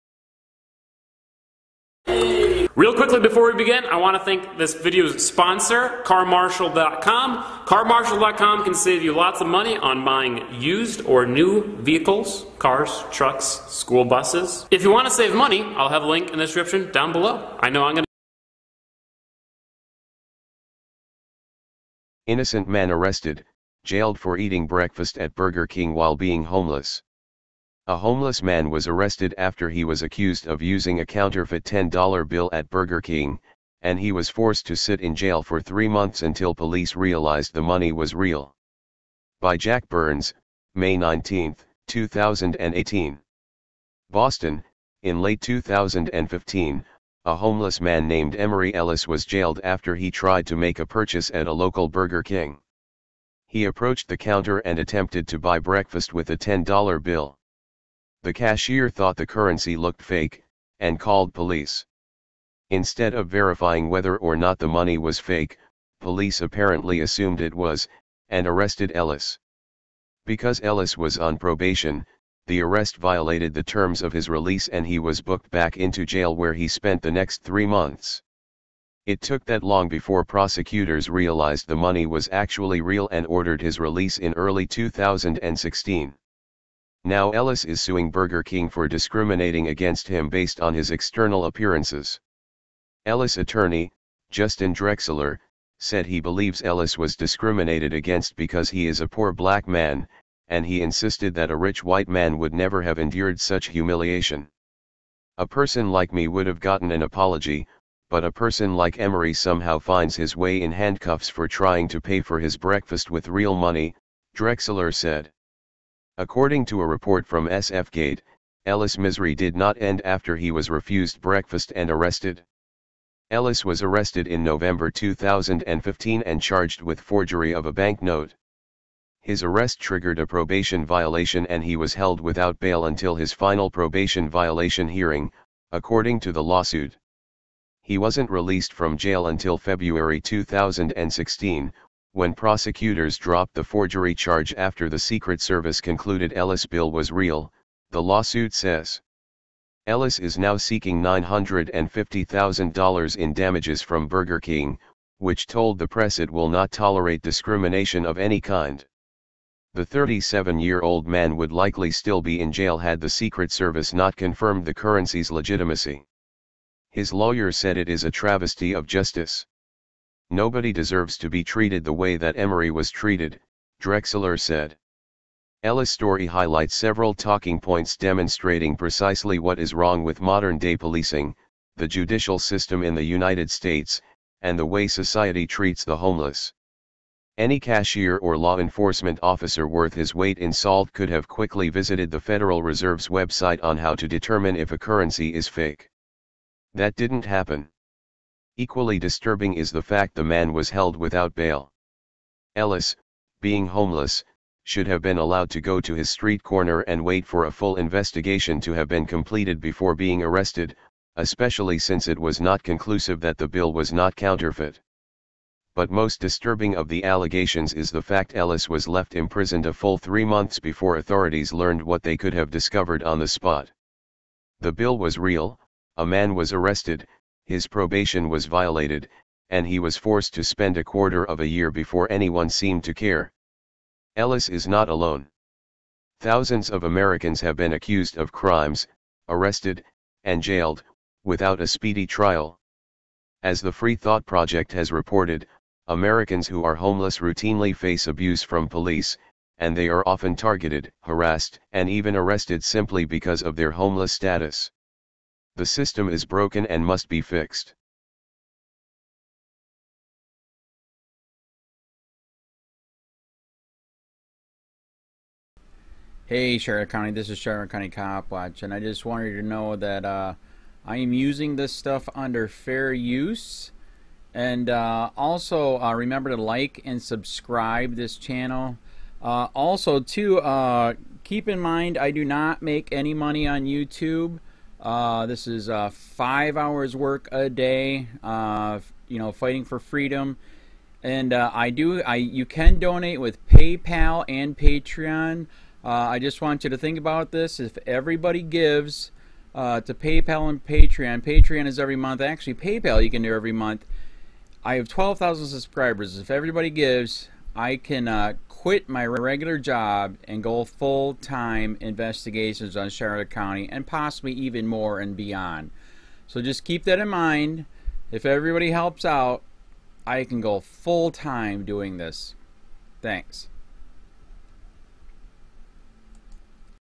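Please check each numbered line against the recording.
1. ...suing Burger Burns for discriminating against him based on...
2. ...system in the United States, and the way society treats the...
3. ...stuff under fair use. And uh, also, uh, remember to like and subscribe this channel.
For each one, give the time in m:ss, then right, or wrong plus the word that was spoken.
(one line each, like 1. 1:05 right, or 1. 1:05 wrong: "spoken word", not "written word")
1. 1:27 wrong: "King", not "Burns"
2. 3:02 right
3. 4:31 right.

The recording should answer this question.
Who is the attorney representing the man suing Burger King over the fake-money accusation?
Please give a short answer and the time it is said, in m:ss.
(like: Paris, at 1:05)
Justin Drexler, at 1:34.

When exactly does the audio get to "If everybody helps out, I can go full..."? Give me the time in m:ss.
5:18.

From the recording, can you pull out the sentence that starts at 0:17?
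I know I'm going to Innocent man arrested, jailed for eating breakfast at Burger King while being homeless.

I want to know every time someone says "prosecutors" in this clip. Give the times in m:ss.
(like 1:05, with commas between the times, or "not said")
1:20, 2:22.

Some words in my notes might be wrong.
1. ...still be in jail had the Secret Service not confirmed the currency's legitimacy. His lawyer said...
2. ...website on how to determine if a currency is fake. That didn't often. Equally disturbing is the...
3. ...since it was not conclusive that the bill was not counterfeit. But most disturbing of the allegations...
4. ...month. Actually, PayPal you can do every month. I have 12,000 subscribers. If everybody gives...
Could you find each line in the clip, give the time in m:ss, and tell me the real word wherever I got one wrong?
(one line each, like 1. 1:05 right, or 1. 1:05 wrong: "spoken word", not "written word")
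1. 2:41 right
2. 3:13 wrong: "happen", not "often"
3. 3:31 right
4. 5:01 right.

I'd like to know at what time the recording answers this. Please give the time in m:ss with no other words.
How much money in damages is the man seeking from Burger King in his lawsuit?
2:31.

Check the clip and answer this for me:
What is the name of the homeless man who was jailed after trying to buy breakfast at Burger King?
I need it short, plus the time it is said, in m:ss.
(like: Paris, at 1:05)
Emery Ellis, at 0:48.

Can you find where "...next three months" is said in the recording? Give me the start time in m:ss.
1:17.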